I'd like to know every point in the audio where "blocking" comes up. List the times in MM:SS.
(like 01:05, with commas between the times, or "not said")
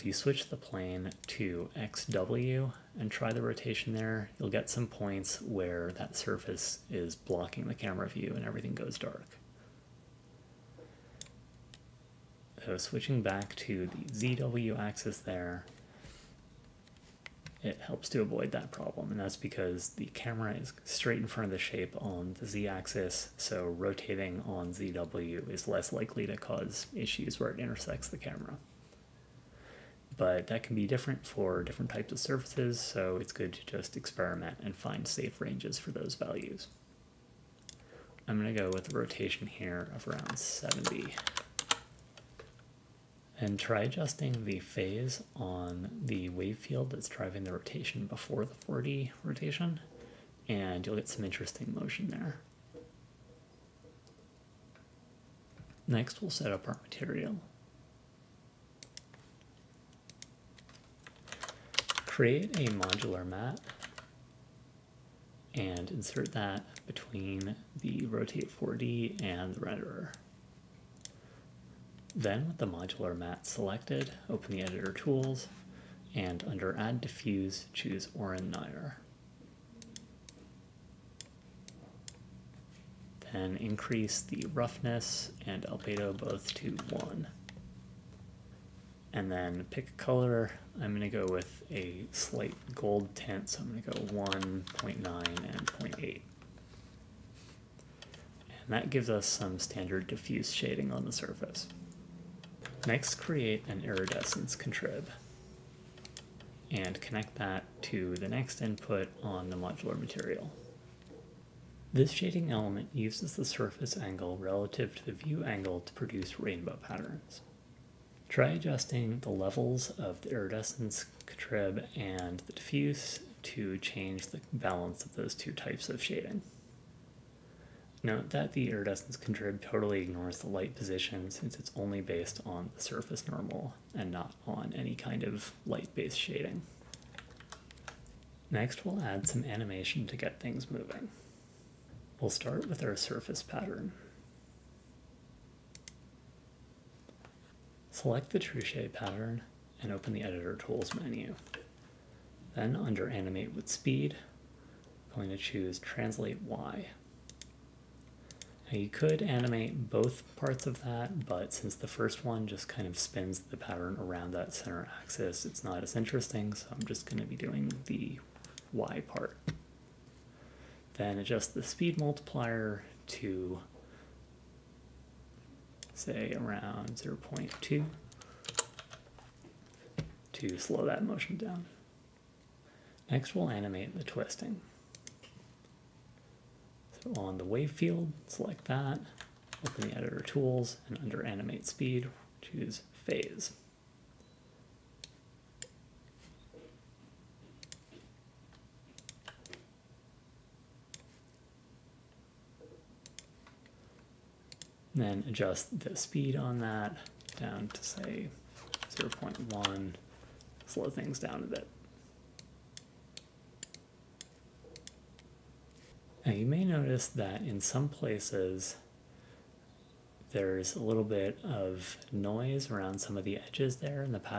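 00:07.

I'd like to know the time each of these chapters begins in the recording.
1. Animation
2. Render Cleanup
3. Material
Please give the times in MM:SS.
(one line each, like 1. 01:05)
1. 02:17
2. 03:34
3. 00:54.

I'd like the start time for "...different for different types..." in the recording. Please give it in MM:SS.
00:30.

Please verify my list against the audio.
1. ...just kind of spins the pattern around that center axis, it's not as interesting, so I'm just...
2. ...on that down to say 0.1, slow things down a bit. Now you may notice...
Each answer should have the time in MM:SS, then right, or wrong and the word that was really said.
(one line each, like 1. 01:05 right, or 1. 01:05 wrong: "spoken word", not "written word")
1. 02:42 right
2. 03:26 right.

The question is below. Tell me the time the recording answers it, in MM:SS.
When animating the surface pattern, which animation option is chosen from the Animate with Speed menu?
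02:35.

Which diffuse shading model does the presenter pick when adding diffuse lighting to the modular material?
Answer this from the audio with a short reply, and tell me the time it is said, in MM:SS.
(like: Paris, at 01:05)
Oren-Nayar, at 01:18.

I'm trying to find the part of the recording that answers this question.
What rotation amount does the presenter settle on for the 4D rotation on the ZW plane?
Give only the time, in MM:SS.
00:40.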